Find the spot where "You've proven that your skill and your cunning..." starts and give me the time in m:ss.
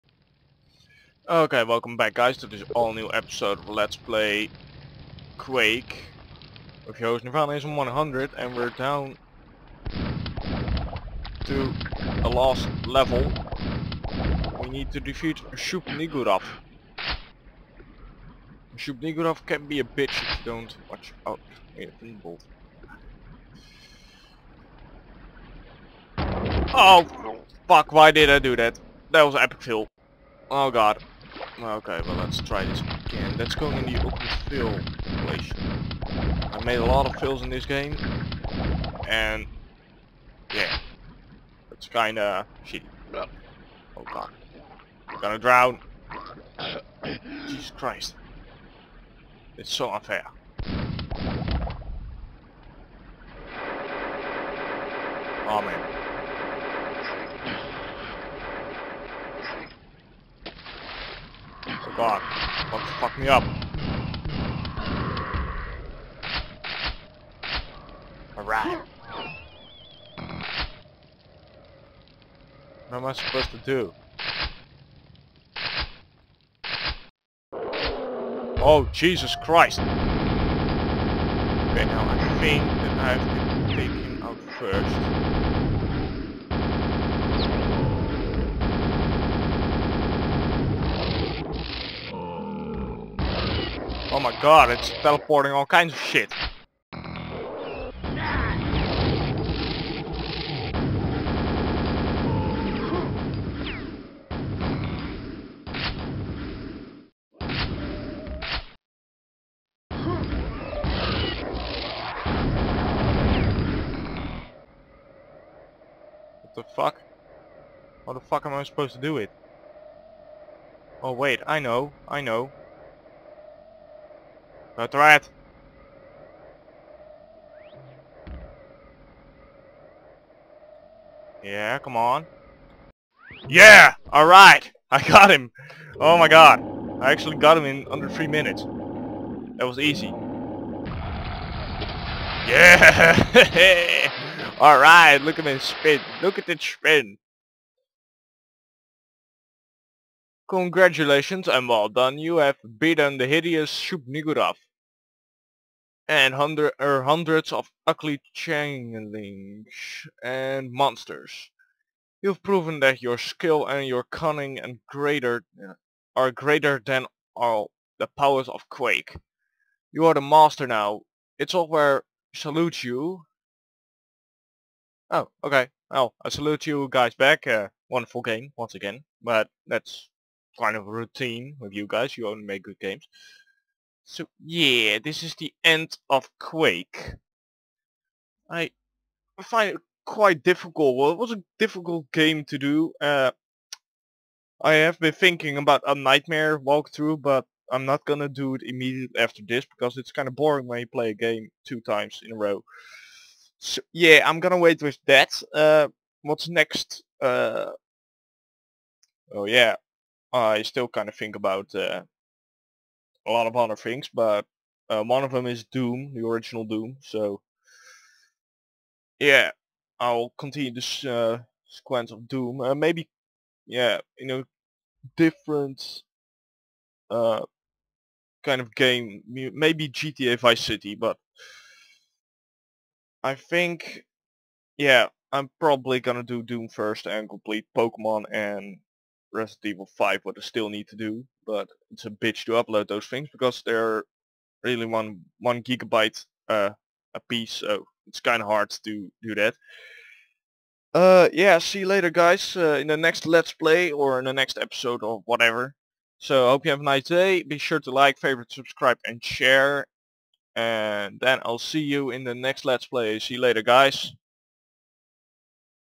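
2:42.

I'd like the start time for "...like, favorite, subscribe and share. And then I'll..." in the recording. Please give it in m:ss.
4:17.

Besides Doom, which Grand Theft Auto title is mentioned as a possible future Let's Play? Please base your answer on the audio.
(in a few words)
GTA Vice City.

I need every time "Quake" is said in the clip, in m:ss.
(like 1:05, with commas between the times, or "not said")
0:05, 2:48, 3:06.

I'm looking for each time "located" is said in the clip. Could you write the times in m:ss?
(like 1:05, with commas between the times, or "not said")
not said.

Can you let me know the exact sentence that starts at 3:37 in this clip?
So yeah, I'll continue this uh, sequence of Doom.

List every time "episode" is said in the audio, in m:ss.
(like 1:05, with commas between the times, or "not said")
0:03, 4:14.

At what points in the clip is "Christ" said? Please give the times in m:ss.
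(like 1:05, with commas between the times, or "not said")
0:47, 1:19.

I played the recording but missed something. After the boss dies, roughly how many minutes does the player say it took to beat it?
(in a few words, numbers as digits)
3.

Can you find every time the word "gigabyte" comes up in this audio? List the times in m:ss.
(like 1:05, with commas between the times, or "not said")
4:05.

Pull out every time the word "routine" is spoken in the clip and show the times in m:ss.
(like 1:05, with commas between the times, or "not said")
3:00.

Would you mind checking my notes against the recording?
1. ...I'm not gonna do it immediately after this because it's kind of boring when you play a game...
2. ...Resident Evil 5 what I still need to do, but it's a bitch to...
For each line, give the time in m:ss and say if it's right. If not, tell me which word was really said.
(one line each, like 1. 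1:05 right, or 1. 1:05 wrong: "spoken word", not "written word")
1. 3:17 right
2. 3:59 right.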